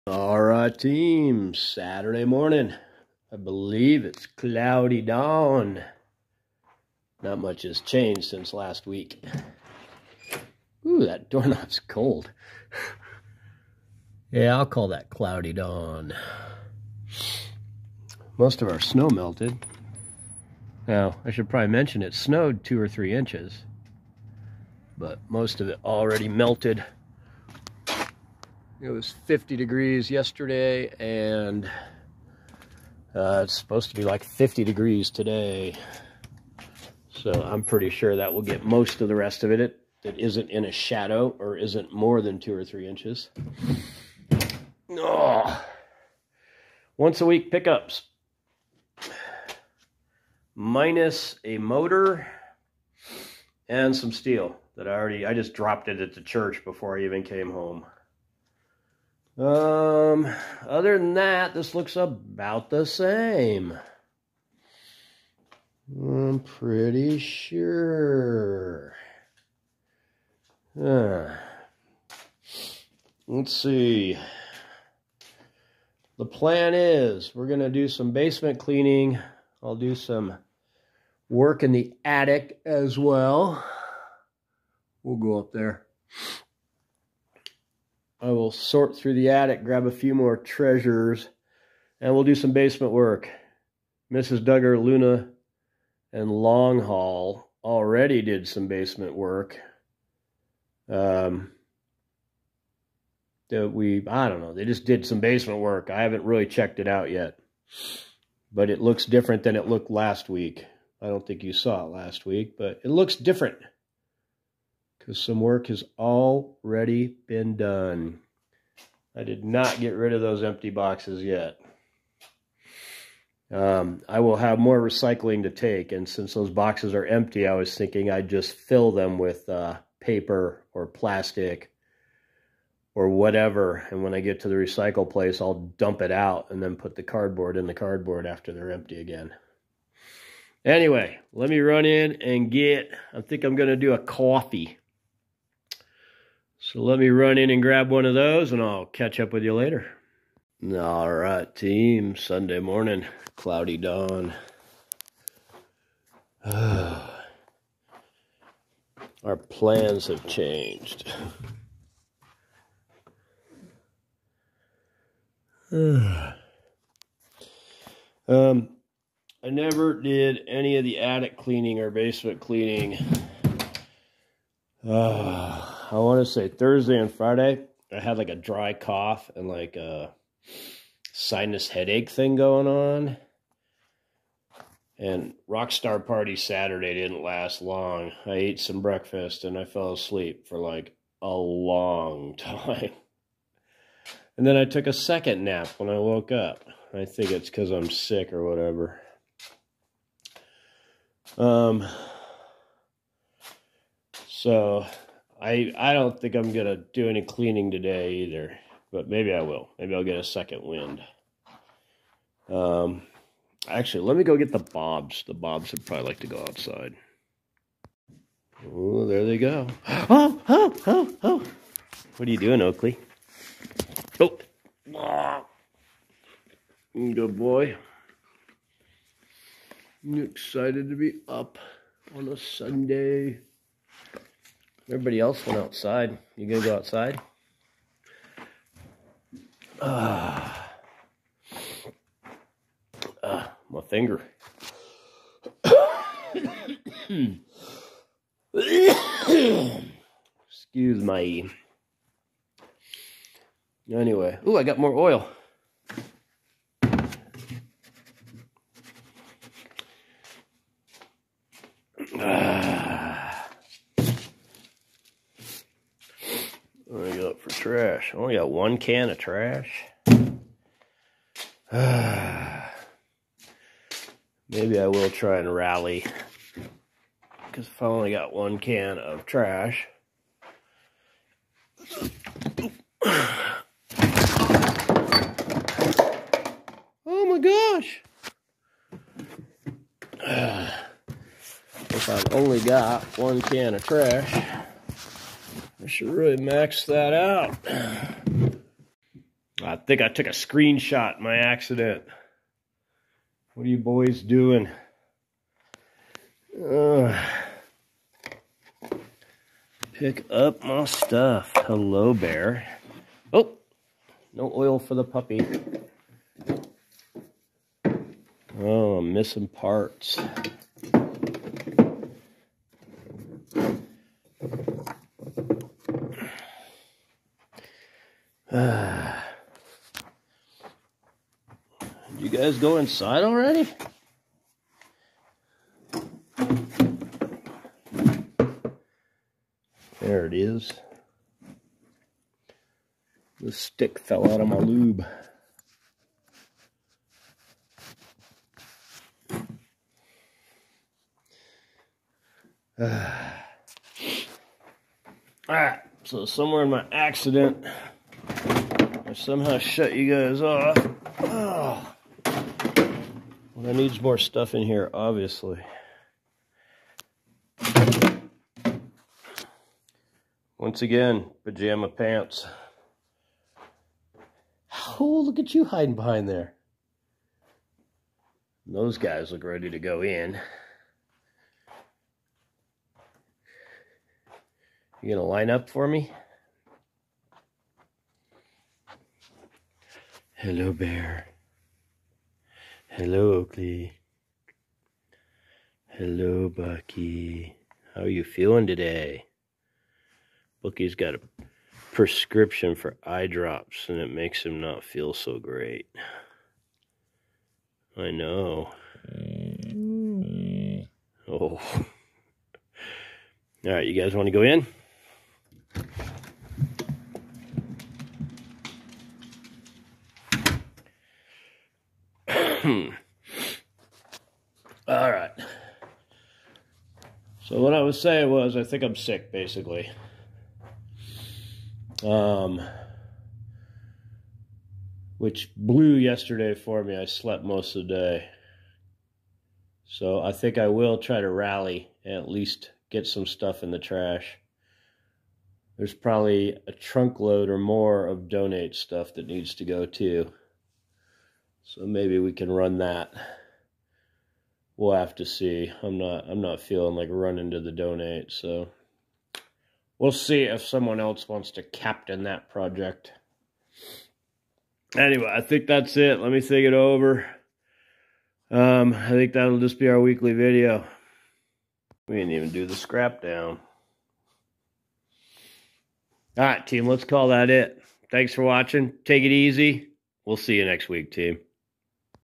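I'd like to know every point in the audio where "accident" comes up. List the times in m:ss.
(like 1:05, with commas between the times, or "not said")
5:01, 5:56.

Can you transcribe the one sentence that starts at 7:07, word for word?
So what I was saying was, I think I'm sick, basically.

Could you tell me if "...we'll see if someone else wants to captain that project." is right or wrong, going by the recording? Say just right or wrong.
right.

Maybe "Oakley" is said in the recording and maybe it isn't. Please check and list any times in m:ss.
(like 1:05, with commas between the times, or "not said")
3:42, 6:33.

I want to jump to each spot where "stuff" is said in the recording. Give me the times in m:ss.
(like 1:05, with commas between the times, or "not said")
5:10, 6:04, 7:23, 7:28.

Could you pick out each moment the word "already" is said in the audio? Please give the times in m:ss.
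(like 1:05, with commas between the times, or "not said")
0:25, 0:54, 1:37, 1:55, 5:33.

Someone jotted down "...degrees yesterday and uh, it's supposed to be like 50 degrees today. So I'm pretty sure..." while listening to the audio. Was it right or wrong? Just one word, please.
right.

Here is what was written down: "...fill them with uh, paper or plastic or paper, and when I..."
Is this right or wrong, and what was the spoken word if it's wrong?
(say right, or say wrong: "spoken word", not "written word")
wrong: "whatever", not "paper".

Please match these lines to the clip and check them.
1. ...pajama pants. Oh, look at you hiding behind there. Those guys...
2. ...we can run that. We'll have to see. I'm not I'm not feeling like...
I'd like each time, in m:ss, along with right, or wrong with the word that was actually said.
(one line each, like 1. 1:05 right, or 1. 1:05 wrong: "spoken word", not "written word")
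1. 6:11 right
2. 7:32 right.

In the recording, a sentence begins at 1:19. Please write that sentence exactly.
I'll do some work in the attic as well.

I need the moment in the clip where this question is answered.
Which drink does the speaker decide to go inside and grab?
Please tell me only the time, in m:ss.
2:23.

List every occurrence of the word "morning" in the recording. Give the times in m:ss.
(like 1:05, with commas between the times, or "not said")
0:02, 2:32.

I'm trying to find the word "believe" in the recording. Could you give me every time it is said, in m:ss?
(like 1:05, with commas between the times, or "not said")
0:03.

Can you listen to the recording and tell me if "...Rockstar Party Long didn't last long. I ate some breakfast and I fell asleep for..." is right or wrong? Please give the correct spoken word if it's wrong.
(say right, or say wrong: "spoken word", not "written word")
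wrong: "Saturday", not "Long".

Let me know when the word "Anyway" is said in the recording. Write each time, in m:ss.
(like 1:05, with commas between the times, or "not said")
2:20, 4:13, 7:44.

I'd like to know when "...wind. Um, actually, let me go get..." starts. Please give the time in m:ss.
3:30.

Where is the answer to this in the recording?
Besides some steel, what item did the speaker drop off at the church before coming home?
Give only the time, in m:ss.
0:51.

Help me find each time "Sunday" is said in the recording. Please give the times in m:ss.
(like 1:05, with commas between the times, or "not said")
2:32, 3:52.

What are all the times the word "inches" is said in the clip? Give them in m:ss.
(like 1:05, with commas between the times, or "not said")
0:23, 0:42.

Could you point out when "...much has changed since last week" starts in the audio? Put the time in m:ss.
0:07.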